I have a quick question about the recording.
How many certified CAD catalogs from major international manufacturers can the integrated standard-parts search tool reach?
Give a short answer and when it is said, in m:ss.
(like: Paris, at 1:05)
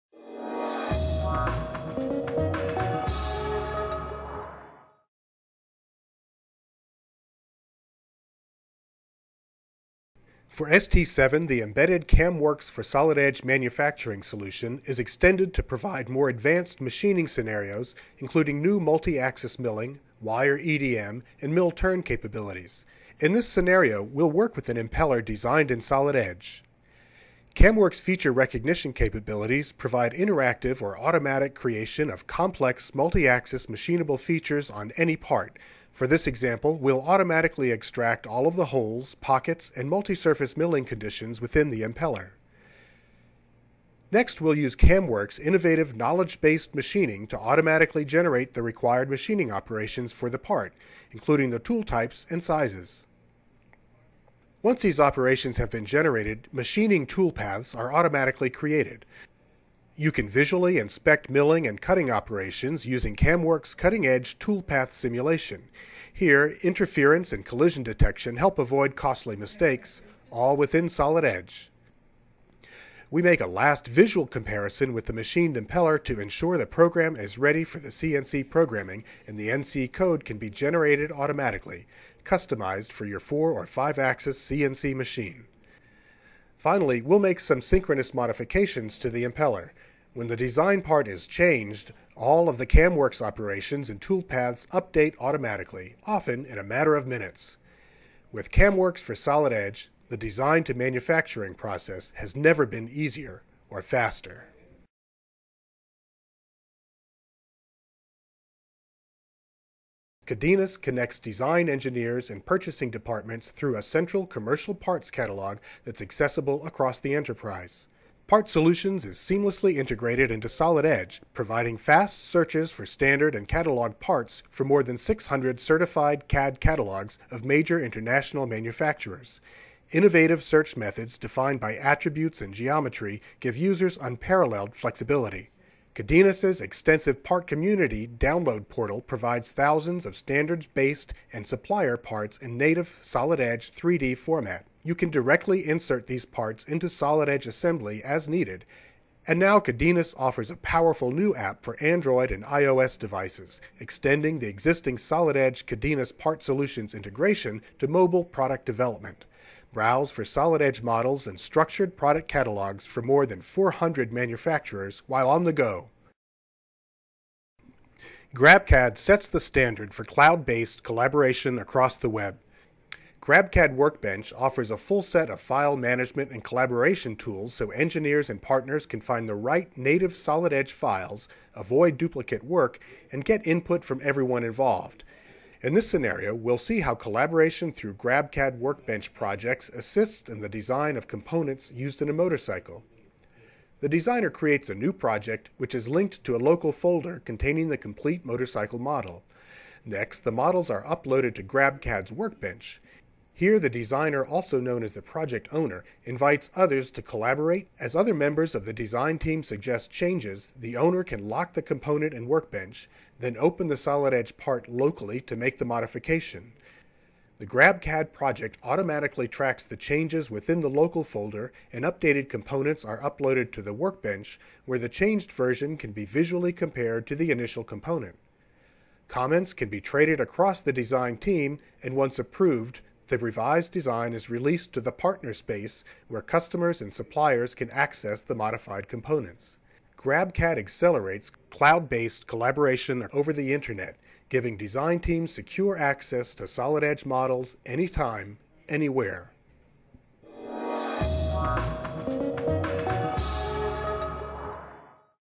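More than 600, at 2:04.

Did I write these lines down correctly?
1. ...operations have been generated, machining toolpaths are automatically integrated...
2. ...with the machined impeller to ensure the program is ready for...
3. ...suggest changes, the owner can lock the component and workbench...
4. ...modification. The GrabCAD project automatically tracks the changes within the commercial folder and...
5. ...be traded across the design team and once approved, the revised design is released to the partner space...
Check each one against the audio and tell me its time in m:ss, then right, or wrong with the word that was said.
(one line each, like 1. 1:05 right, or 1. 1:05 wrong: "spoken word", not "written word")
1. 0:54 wrong: "created", not "integrated"
2. 1:14 right
3. 3:29 right
4. 3:35 wrong: "local", not "commercial"
5. 3:49 right.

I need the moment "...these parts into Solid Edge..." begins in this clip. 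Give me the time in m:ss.
2:26.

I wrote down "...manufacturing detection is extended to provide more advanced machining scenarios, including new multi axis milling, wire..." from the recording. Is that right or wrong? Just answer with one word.
wrong.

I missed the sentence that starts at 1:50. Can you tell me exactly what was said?
Cadenas connects design engineers and purchasing departments through a central commercial parts catalog that's accessible across the enterprise.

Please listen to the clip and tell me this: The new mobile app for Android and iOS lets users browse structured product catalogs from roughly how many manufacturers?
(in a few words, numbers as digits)
More than 400.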